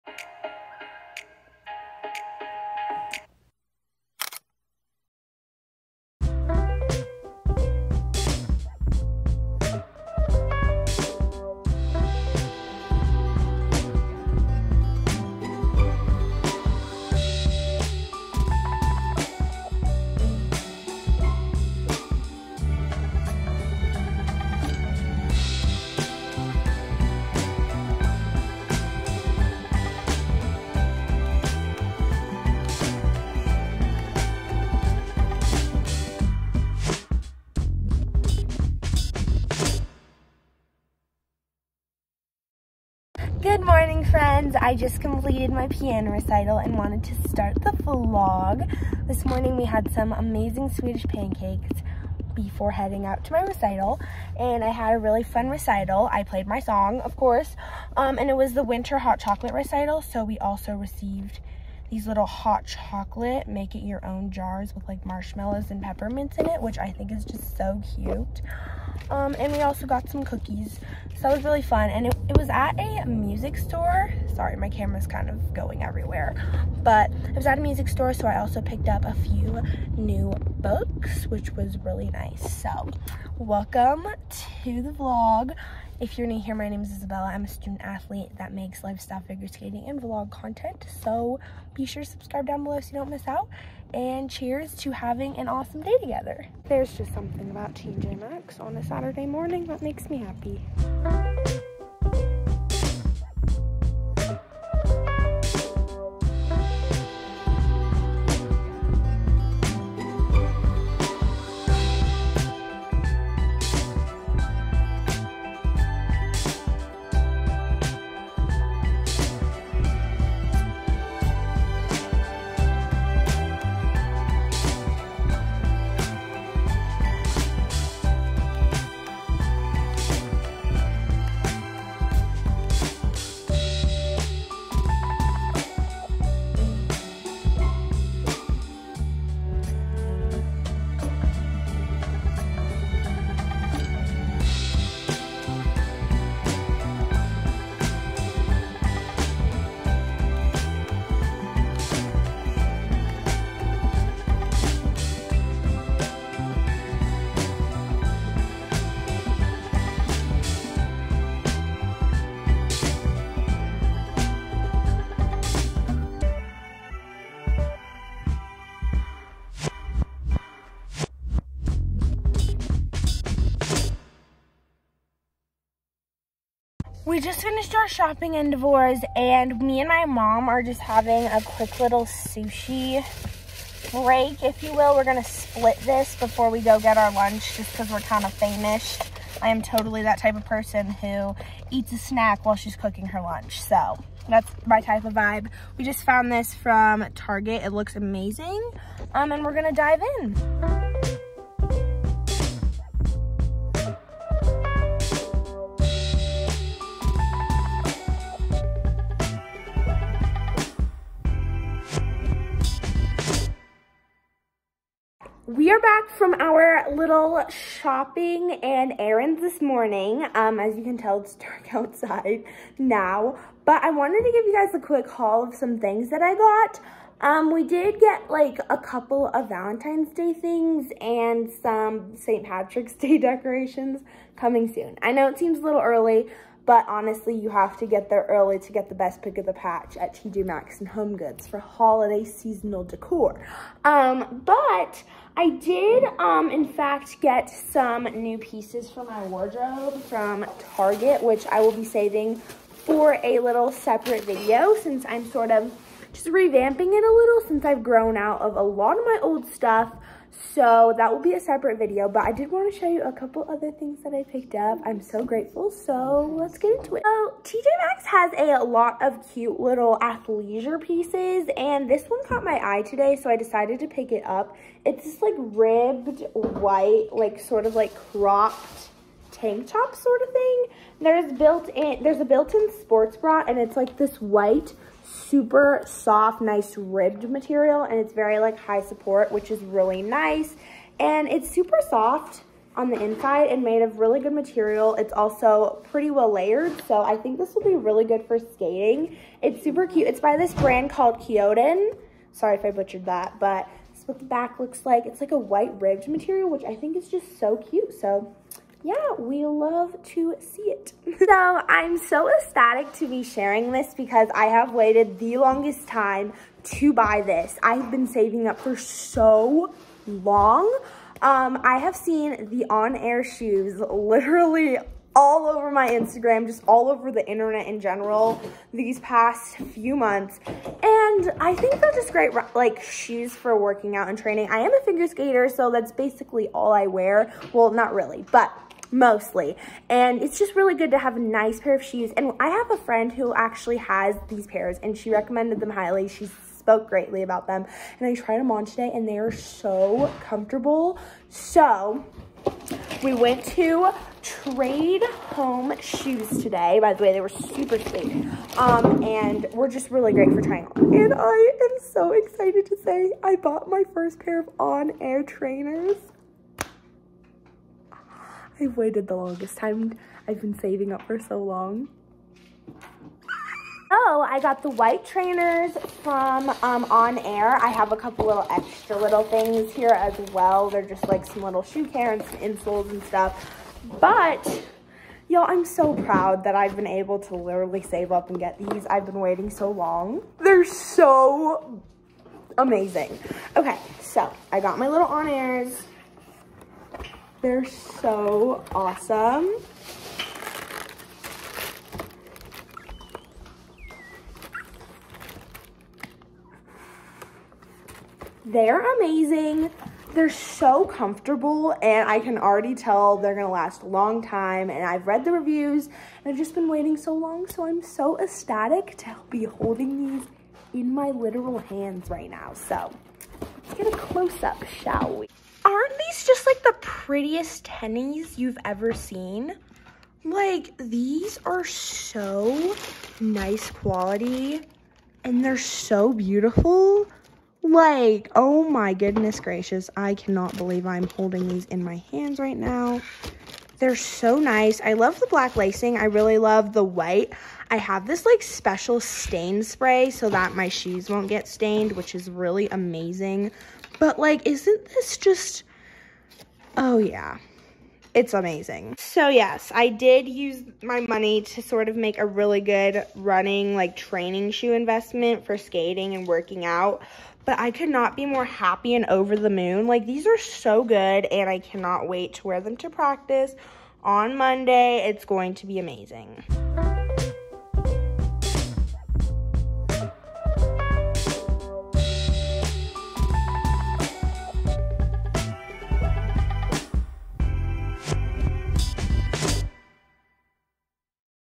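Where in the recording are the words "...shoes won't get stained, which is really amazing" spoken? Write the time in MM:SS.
07:30.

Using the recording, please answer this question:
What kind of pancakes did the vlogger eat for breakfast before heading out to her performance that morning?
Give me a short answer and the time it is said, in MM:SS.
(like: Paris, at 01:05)
Swedish pancakes, at 00:50.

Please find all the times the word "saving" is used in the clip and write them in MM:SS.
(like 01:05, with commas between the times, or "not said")
04:11, 05:18, 06:10.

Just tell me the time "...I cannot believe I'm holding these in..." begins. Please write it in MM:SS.
07:19.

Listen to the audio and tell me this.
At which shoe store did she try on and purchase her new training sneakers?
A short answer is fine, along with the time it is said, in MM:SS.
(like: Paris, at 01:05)
Trade Home Shoes, at 05:54.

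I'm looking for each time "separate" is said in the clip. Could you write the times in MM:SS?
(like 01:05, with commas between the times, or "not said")
04:13, 04:21.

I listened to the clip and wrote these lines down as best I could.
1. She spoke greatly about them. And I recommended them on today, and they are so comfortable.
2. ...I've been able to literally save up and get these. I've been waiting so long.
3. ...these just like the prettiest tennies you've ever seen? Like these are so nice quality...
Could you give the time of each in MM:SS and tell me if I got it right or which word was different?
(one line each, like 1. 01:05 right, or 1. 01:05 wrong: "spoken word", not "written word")
1. 05:46 wrong: "tried", not "recommended"
2. 06:26 right
3. 07:05 right.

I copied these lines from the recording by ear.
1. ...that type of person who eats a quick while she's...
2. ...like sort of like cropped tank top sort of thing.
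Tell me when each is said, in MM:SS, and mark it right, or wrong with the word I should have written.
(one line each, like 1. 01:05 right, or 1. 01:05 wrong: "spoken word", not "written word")
1. 03:10 wrong: "snack", not "quick"
2. 04:37 right.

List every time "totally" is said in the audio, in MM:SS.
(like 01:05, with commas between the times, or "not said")
03:09.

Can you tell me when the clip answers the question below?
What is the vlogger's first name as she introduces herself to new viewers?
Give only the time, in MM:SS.
01:26.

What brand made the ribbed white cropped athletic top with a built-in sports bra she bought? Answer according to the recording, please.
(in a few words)
Kyodan.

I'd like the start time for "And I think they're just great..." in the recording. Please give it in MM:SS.
05:30.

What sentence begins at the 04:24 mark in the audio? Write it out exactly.
I'm so grateful, so let's get into it.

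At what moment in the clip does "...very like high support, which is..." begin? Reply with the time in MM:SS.
04:48.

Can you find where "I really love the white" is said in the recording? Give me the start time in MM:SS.
07:25.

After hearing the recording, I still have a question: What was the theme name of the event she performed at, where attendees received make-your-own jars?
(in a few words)
winter hot chocolate recital.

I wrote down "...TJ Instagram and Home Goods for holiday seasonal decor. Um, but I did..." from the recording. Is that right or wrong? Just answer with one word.
wrong.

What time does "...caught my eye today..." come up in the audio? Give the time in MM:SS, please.
04:32.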